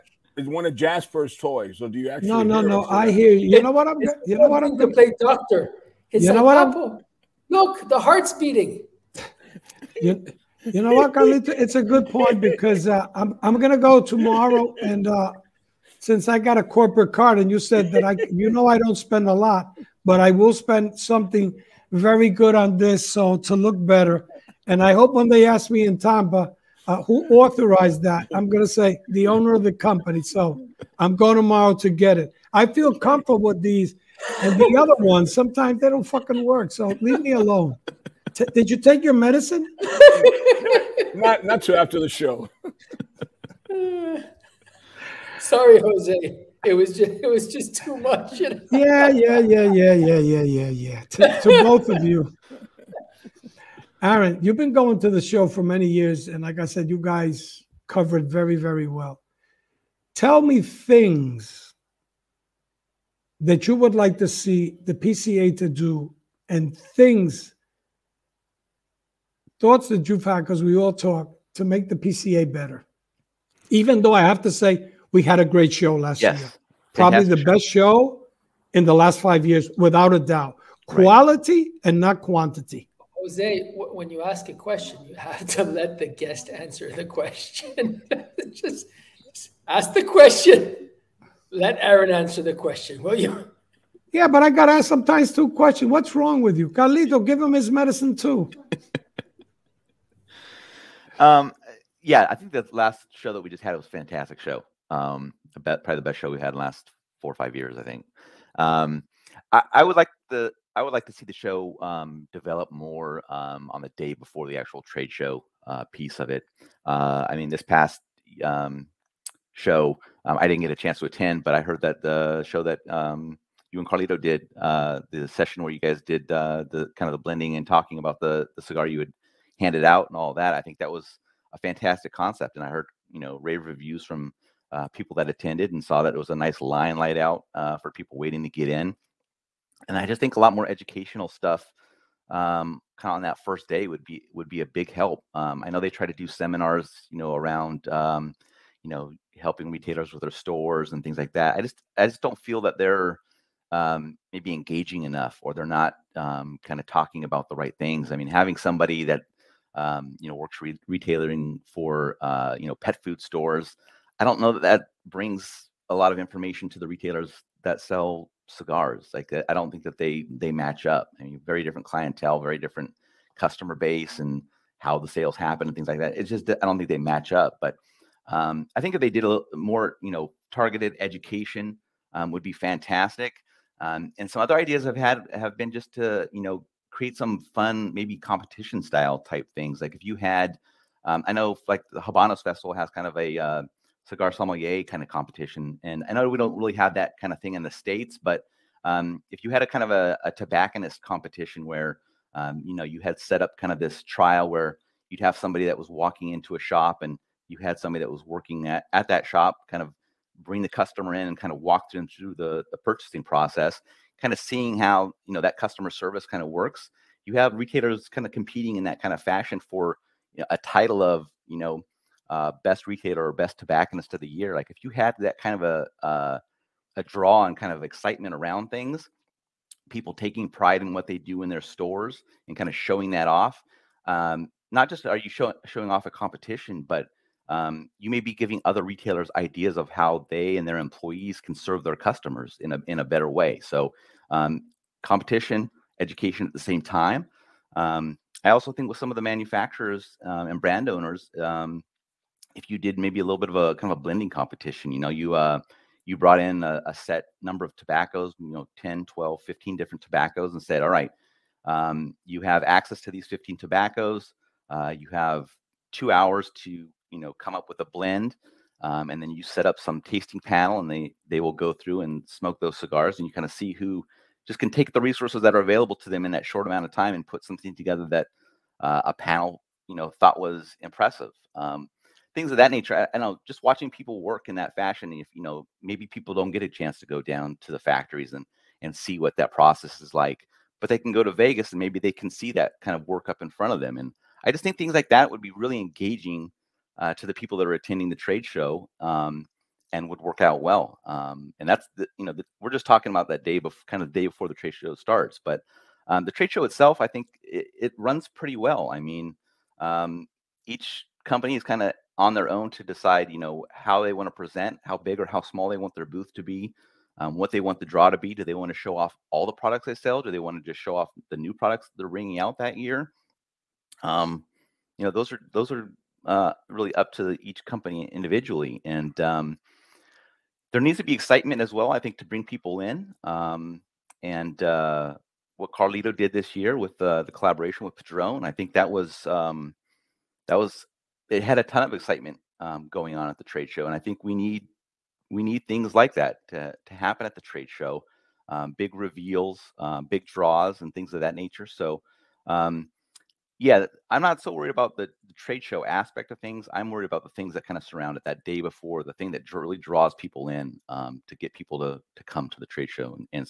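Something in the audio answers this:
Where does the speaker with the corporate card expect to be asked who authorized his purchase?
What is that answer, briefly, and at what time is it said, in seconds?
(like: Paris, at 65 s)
Tampa, at 25 s.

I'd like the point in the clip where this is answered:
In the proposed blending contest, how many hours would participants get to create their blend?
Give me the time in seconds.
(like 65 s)
265 s.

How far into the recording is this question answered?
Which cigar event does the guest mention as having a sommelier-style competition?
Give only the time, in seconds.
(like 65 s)
192 s.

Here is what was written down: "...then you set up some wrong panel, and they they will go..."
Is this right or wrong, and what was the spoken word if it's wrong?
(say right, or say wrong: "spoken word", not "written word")
wrong: "tasting", not "wrong".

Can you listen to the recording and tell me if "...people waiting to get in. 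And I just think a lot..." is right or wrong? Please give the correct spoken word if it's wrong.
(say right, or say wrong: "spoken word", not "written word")
right.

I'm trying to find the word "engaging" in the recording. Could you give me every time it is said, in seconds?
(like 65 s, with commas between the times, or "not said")
154 s, 295 s.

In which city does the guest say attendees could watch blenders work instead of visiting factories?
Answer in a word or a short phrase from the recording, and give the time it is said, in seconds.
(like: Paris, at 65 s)
Vegas, at 291 s.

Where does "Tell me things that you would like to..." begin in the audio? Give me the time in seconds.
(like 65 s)
60 s.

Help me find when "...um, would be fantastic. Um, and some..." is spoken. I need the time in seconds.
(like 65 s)
182 s.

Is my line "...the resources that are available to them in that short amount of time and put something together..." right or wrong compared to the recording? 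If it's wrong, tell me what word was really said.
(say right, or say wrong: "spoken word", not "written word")
right.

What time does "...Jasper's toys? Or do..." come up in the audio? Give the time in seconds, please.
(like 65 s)
0 s.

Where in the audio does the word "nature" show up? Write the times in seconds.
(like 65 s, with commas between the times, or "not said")
282 s, 351 s.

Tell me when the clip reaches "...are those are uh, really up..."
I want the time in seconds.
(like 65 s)
325 s.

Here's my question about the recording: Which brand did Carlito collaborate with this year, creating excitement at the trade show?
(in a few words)
Padron.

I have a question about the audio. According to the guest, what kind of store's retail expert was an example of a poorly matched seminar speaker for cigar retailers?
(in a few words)
pet food stores.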